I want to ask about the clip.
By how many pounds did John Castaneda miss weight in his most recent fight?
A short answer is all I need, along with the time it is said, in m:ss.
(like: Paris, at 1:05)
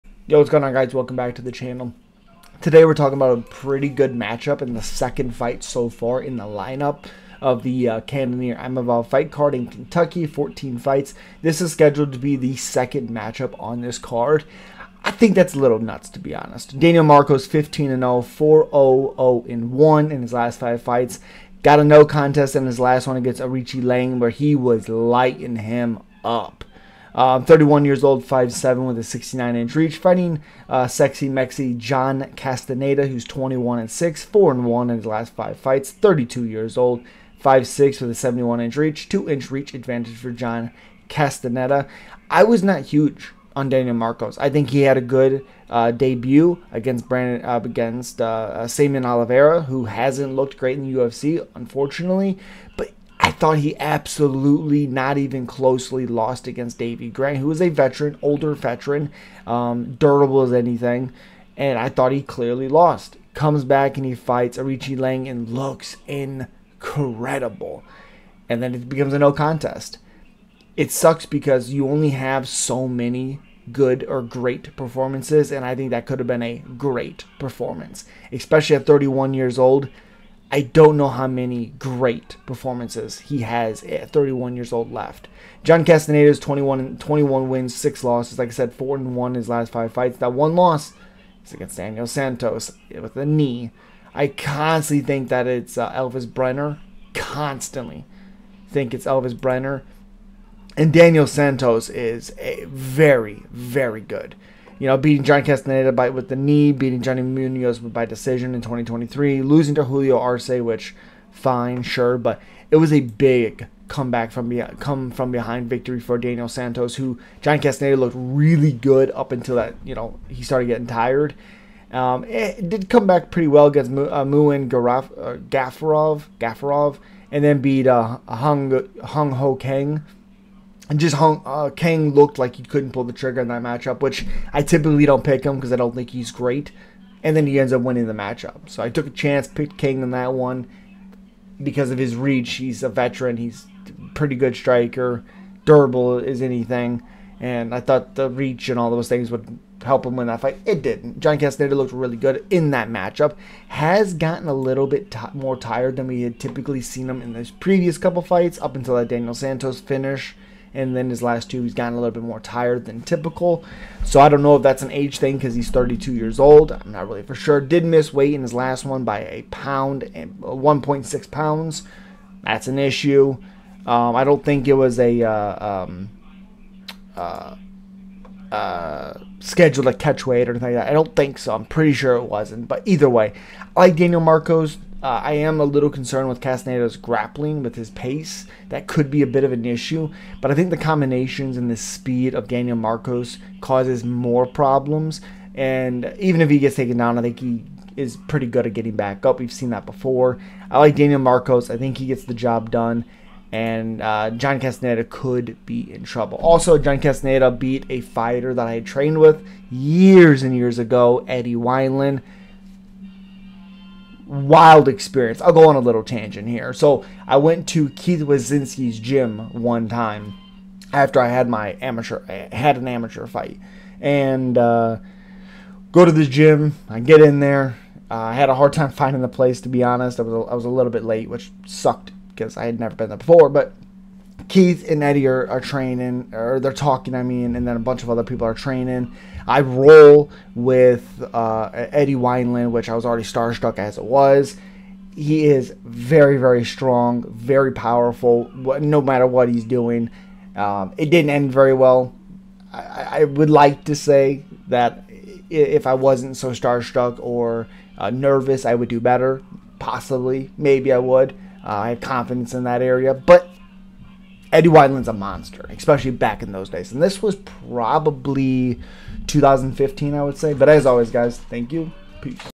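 1.6 pounds, at 2:50.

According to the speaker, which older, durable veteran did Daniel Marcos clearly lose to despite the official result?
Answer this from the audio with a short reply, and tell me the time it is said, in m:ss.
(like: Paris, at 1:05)
Davy Grant, at 0:56.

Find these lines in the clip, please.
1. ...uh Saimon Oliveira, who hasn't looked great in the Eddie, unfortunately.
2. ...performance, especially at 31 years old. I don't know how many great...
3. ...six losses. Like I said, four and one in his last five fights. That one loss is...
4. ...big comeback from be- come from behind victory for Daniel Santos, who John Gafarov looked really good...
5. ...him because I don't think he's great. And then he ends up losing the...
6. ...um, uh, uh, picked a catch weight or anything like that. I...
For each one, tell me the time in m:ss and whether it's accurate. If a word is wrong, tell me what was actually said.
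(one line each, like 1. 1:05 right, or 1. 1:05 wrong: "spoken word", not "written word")
1. 0:48 wrong: "UFC", not "Eddie"
2. 1:17 right
3. 1:27 right
4. 1:53 wrong: "Castaneda", not "Gafarov"
5. 2:15 wrong: "winning", not "losing"
6. 2:55 wrong: "scheduled", not "picked".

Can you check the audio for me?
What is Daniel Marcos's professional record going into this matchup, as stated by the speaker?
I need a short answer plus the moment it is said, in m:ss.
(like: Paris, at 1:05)
15-0, at 0:17.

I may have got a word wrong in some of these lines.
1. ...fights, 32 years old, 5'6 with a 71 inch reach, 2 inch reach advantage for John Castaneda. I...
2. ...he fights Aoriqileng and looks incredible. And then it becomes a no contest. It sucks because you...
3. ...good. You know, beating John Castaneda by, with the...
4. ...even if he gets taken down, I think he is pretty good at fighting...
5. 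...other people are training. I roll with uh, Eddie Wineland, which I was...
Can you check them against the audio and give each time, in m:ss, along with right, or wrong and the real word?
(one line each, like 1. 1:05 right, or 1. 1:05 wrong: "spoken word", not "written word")
1. 0:35 right
2. 1:04 right
3. 1:44 right
4. 3:16 wrong: "getting", not "fighting"
5. 3:58 right.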